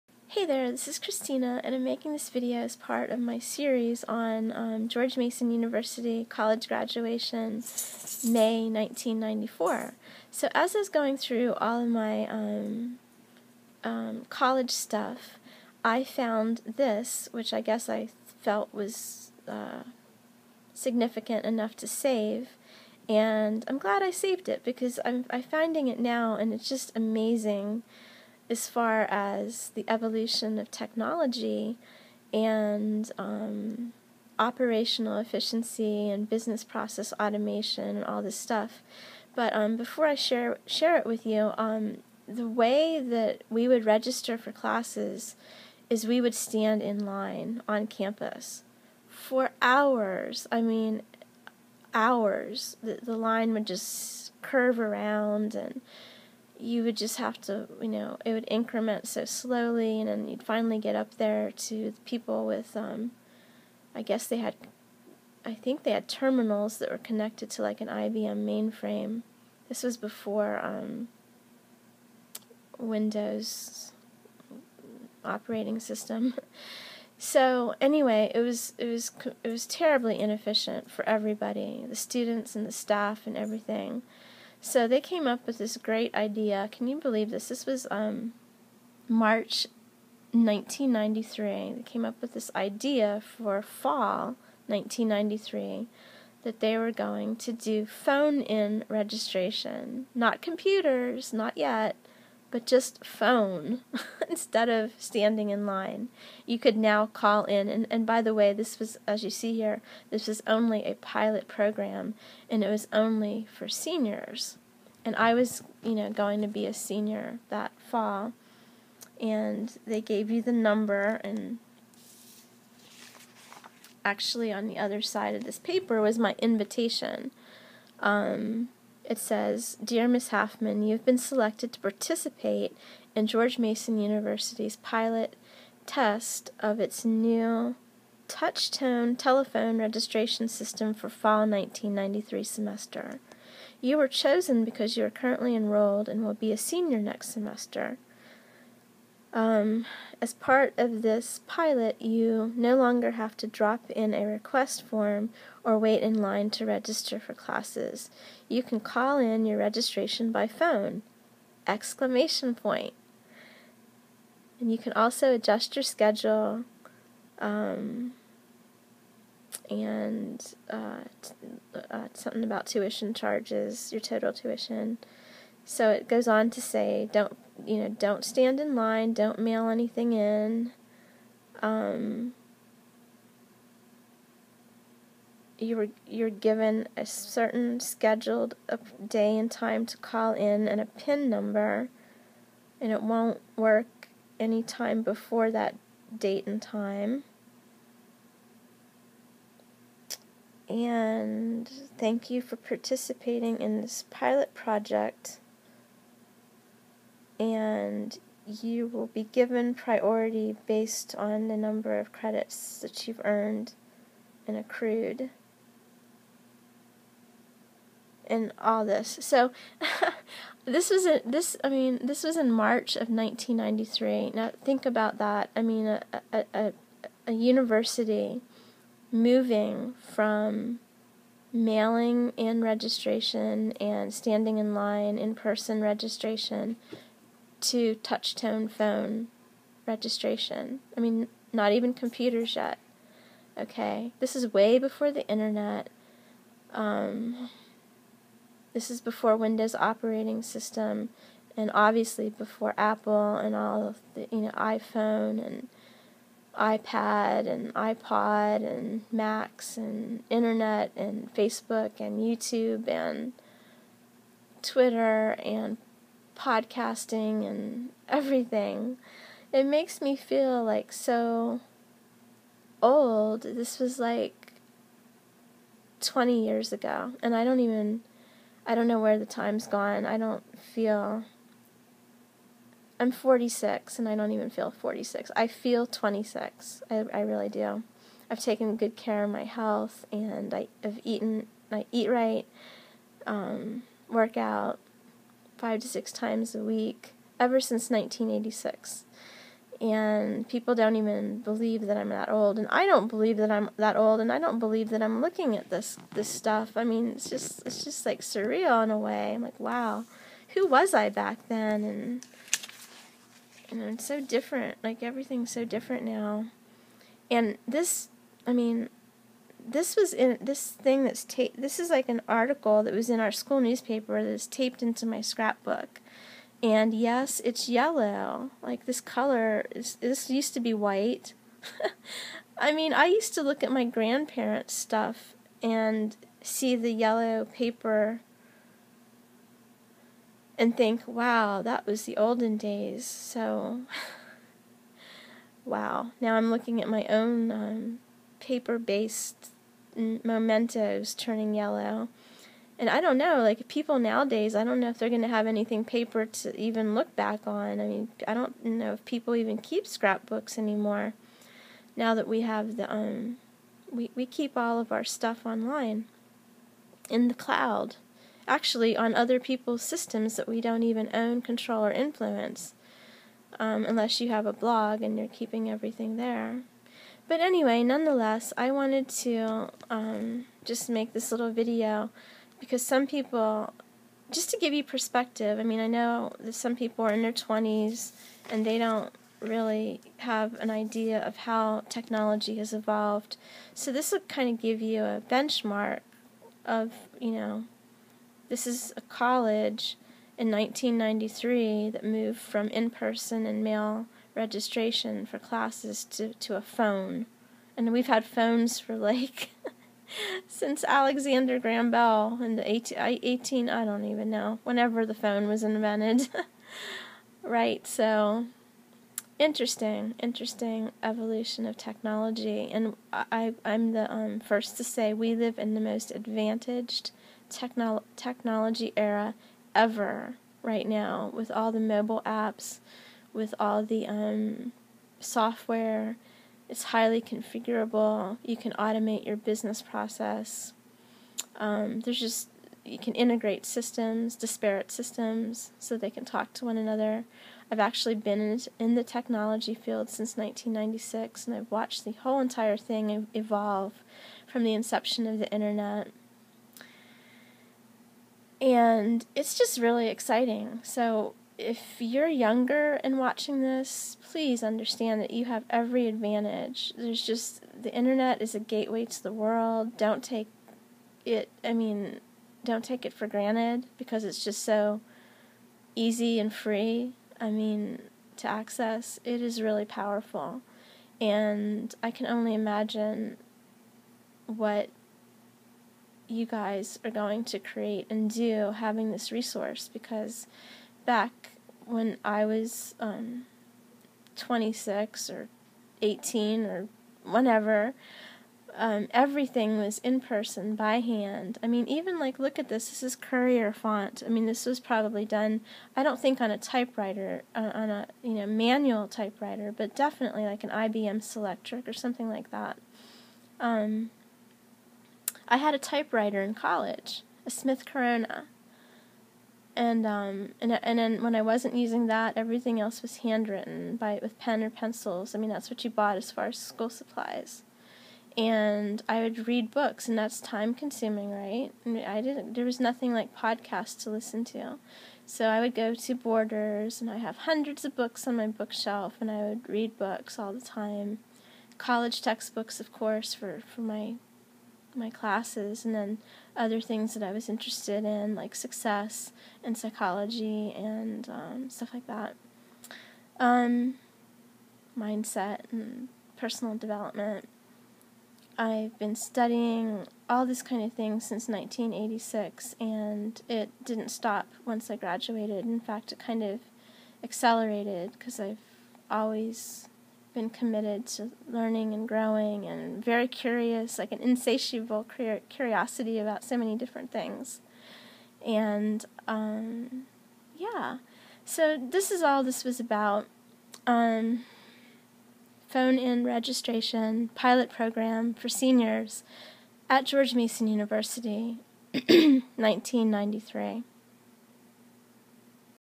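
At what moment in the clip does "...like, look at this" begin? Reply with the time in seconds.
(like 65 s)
502 s.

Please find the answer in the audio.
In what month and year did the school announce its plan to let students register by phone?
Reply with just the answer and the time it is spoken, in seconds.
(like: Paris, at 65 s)
March 1993, at 89 s.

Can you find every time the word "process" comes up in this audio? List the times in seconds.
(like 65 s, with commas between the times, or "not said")
36 s, 439 s.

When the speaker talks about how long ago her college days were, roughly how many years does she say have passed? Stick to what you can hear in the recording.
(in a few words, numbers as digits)
20 years.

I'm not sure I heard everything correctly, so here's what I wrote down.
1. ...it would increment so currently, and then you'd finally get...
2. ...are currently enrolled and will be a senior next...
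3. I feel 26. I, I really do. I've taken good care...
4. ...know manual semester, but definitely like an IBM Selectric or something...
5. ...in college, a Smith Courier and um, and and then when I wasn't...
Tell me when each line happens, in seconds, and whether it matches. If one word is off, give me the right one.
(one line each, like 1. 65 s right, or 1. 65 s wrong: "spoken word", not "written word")
1. 58 s wrong: "slowly", not "currently"
2. 145 s right
3. 285 s right
4. 508 s wrong: "typewriter", not "semester"
5. 516 s wrong: "Corona", not "Courier".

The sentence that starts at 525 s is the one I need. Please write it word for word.
I mean, that's what you bought as far as school supplies.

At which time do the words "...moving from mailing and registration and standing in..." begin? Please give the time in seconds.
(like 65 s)
229 s.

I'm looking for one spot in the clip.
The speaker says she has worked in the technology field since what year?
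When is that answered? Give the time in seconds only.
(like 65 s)
450 s.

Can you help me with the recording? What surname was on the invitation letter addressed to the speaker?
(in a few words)
Haftman.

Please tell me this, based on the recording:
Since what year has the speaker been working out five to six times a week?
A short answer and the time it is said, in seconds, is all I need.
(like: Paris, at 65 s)
1986, at 297 s.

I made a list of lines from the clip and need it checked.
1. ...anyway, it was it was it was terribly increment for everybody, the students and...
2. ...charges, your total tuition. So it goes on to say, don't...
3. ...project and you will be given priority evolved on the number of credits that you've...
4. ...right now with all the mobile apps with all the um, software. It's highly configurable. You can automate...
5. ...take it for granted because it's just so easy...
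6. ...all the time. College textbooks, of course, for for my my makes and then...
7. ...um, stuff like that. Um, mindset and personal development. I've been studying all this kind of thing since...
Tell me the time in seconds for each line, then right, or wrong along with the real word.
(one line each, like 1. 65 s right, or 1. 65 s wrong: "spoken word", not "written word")
1. 77 s wrong: "inefficient", not "increment"
2. 173 s right
3. 204 s wrong: "based", not "evolved"
4. 430 s right
5. 472 s right
6. 540 s wrong: "classes", not "makes"
7. 551 s right.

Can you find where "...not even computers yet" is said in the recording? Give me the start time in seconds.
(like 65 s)
241 s.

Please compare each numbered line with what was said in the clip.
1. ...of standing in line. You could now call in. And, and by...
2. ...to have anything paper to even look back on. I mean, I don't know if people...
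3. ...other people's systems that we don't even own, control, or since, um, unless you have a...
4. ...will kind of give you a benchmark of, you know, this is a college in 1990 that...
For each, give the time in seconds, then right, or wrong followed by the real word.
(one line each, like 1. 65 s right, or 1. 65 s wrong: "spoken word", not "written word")
1. 104 s right
2. 355 s right
3. 369 s wrong: "influence", not "since"
4. 394 s wrong: "1993", not "1990".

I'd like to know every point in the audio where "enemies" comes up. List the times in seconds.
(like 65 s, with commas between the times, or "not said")
not said.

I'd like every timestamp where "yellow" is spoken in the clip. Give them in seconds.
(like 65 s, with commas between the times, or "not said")
327 s, 336 s, 351 s.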